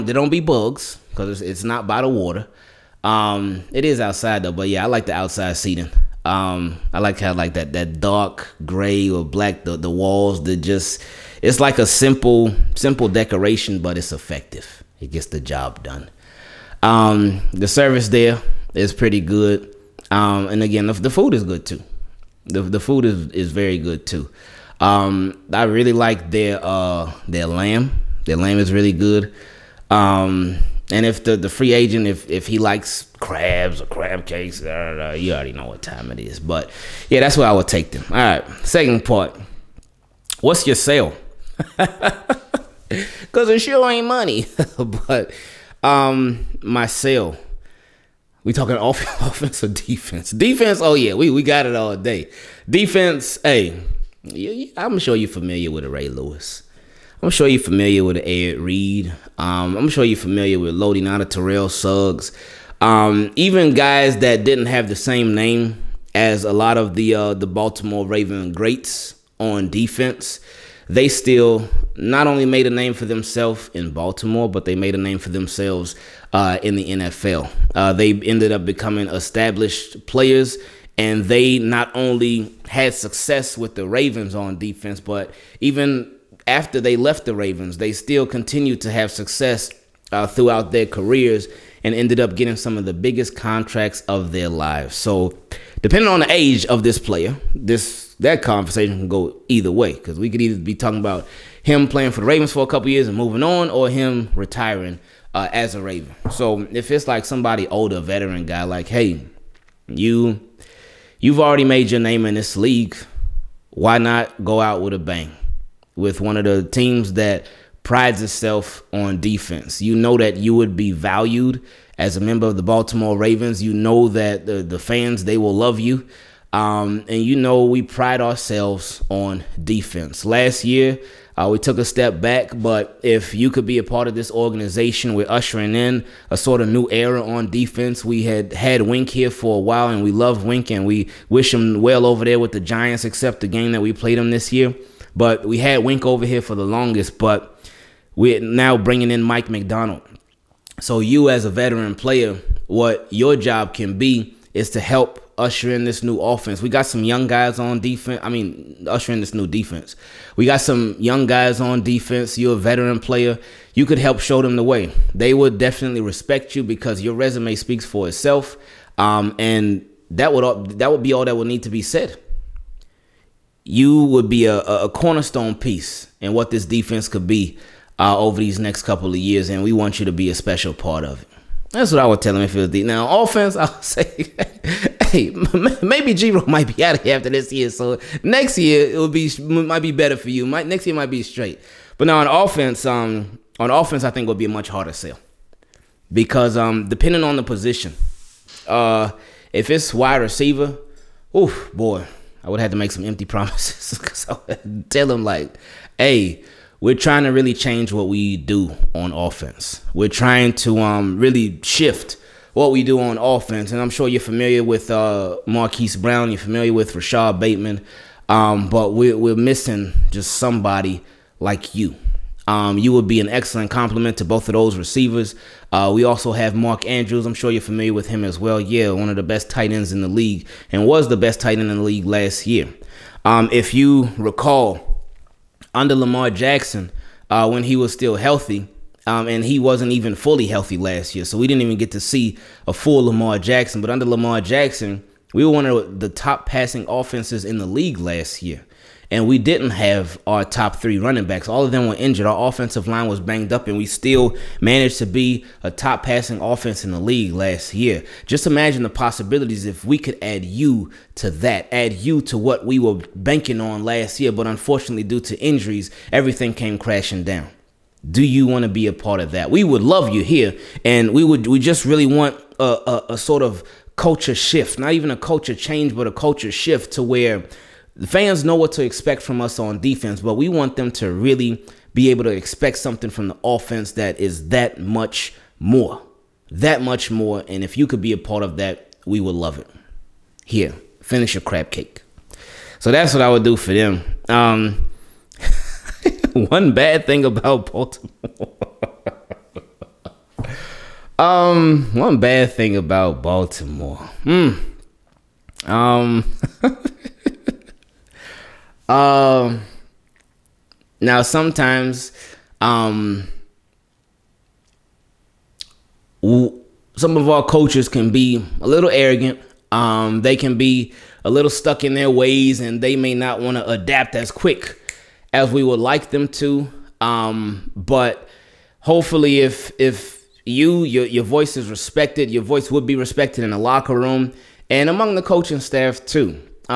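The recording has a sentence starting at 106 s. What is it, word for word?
So, if it's like somebody older, veteran guy, like, hey, you, you've already made your name in this league.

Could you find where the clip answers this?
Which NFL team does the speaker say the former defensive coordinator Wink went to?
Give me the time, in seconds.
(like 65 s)
142 s.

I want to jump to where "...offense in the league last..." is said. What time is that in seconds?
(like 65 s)
256 s.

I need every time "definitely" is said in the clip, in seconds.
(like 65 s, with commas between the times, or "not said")
165 s.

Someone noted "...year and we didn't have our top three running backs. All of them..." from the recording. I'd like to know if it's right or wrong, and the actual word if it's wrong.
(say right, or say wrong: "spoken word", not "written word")
right.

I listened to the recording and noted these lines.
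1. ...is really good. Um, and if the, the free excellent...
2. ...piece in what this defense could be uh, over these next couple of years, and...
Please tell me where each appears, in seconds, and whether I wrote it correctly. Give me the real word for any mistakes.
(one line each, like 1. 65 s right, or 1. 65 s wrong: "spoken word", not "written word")
1. 28 s wrong: "agent", not "excellent"
2. 175 s right.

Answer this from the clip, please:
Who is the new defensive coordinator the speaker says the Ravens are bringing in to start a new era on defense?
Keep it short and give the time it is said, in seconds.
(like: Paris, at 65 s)
Mike Macdonald, at 149 s.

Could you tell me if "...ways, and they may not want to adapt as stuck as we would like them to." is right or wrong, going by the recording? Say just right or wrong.
wrong.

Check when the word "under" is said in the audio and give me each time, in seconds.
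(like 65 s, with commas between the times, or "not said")
235 s, 243 s.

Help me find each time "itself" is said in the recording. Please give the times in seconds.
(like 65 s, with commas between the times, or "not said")
118 s, 168 s.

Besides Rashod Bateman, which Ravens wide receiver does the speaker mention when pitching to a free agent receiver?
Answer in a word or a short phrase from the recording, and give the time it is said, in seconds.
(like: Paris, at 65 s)
Marquise Brown, at 215 s.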